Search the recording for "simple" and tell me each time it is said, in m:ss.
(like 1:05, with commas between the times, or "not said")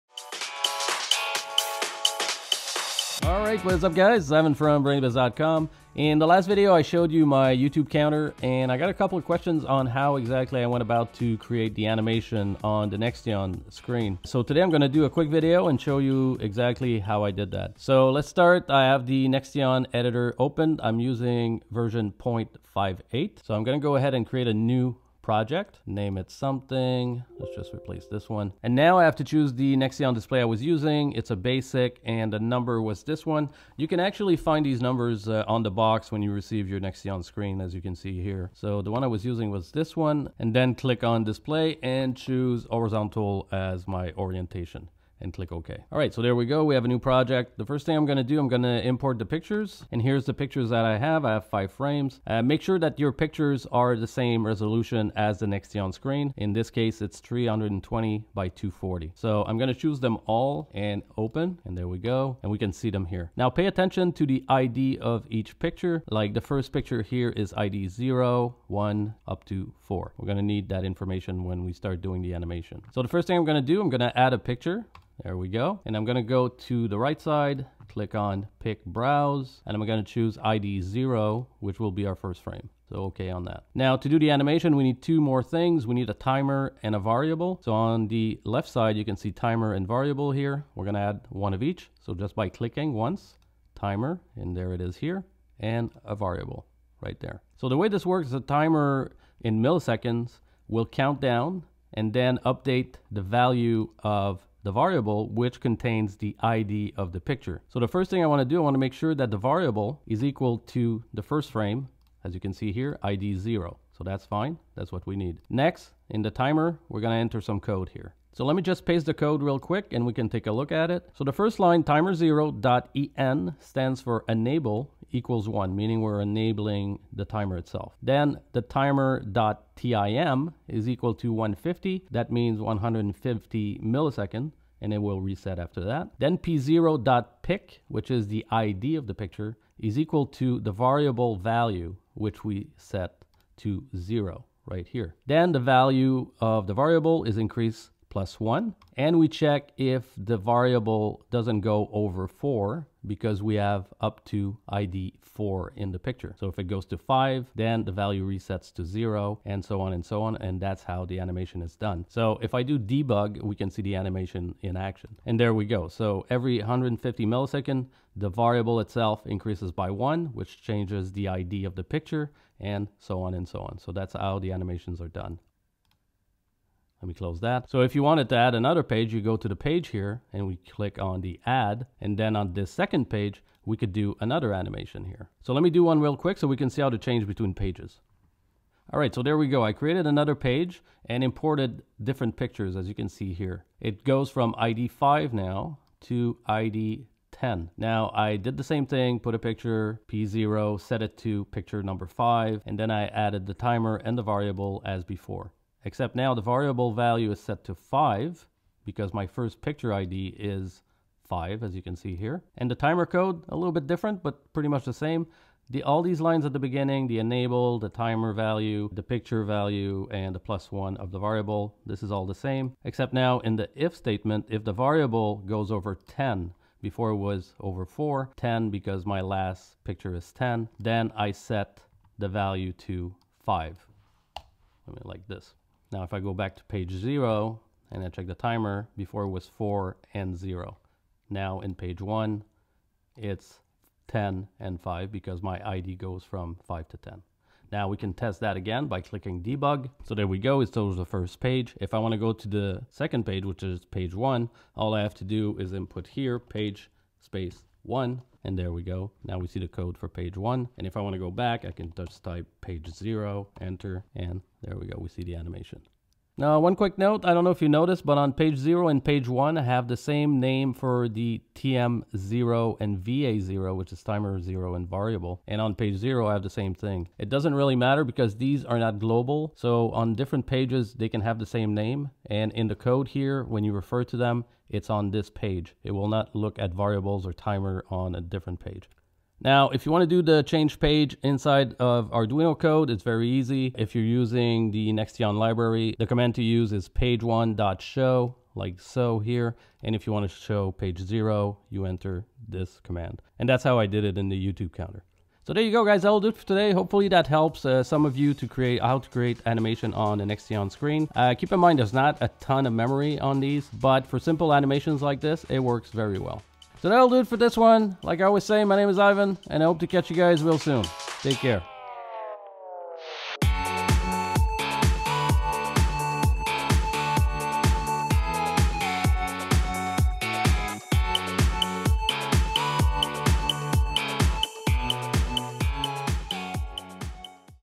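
5:14.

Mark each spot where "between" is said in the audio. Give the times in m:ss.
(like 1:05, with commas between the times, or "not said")
3:07.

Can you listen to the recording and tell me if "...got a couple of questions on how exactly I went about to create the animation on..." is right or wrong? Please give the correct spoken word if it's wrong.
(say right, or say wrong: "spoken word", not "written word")
right.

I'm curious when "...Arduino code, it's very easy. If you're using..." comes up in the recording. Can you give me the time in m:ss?
4:52.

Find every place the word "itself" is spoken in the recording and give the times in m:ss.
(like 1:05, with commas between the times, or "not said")
2:07, 2:48.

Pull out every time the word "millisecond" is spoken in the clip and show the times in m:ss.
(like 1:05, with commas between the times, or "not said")
1:39, 2:13, 2:47.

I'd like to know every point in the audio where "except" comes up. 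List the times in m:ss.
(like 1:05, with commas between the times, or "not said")
3:25, 3:42.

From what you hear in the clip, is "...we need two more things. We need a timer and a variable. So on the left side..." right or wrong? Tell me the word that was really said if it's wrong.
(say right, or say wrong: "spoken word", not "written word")
right.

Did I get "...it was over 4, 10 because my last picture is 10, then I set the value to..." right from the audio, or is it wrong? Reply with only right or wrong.
right.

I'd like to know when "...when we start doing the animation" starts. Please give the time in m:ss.
1:11.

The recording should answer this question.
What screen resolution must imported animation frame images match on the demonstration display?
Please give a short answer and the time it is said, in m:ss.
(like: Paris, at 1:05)
320 by 240, at 0:57.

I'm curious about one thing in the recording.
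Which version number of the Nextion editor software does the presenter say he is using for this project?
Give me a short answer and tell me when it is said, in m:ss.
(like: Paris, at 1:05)
0.58, at 0:22.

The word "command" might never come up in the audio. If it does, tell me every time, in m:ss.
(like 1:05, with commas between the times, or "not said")
4:56, 5:02.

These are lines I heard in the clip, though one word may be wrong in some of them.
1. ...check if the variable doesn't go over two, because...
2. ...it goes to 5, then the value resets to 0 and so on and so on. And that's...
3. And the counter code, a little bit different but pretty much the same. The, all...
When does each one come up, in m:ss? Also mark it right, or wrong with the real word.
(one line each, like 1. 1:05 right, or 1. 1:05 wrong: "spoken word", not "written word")
1. 2:29 wrong: "four", not "two"
2. 2:36 right
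3. 3:32 wrong: "timer", not "counter".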